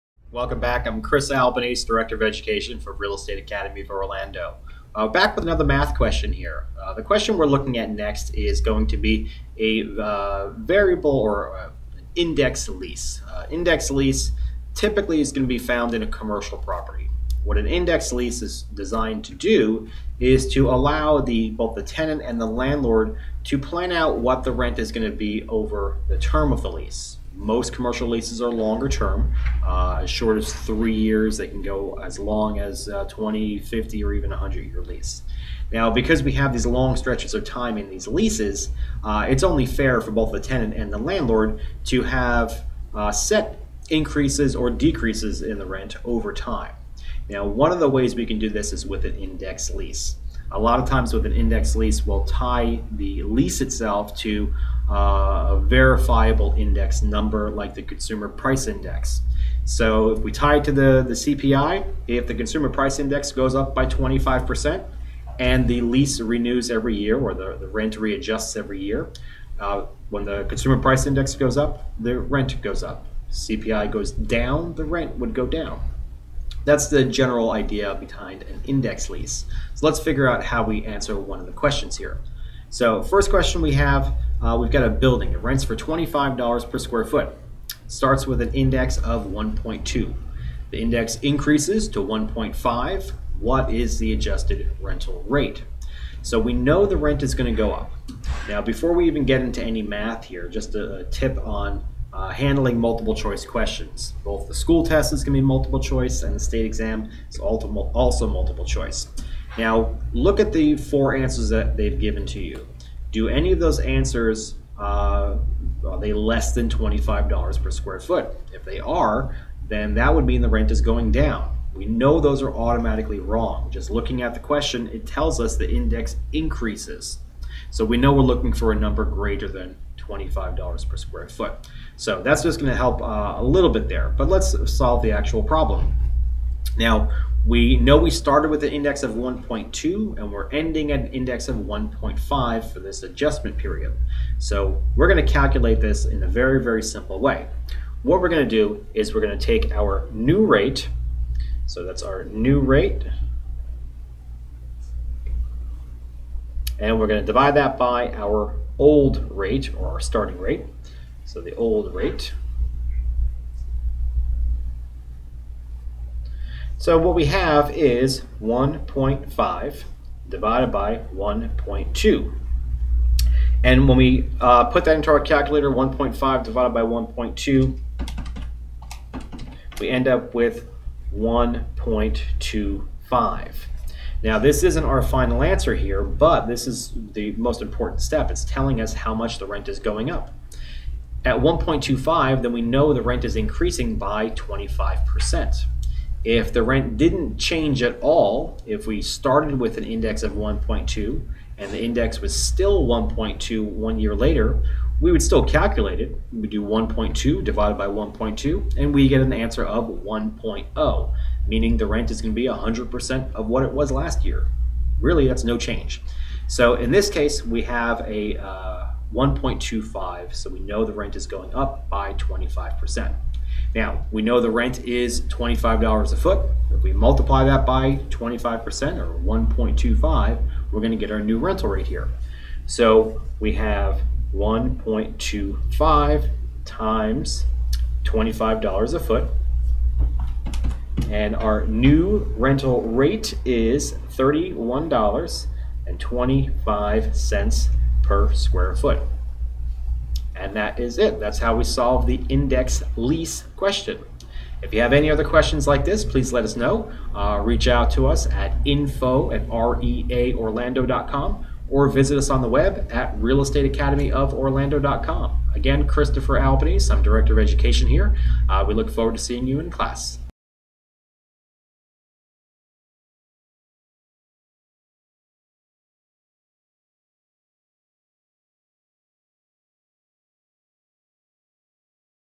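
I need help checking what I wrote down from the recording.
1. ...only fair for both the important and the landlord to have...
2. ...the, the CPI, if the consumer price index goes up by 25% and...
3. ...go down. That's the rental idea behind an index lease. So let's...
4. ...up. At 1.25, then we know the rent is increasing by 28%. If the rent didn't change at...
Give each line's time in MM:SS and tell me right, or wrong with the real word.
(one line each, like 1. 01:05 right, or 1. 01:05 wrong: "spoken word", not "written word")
1. 00:39 wrong: "tenant", not "important"
2. 01:00 right
3. 01:15 wrong: "general", not "rental"
4. 03:10 wrong: "25", not "28".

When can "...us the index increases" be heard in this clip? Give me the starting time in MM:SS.
02:05.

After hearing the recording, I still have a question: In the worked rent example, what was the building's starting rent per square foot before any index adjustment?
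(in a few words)
$25.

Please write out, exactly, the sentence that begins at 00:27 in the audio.
Most commercial leases are longer term, uh, as short as three years.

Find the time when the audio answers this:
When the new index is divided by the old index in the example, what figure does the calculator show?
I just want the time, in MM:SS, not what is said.
02:59.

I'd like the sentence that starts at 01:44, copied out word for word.
Both the school test is going to be multiple choice and the state exam is also multiple choice.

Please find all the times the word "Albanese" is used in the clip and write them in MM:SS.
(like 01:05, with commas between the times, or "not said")
00:01, 04:26.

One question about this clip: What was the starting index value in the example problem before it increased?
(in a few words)
1.2.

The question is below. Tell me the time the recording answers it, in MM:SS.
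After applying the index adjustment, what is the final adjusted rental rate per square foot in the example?
04:04.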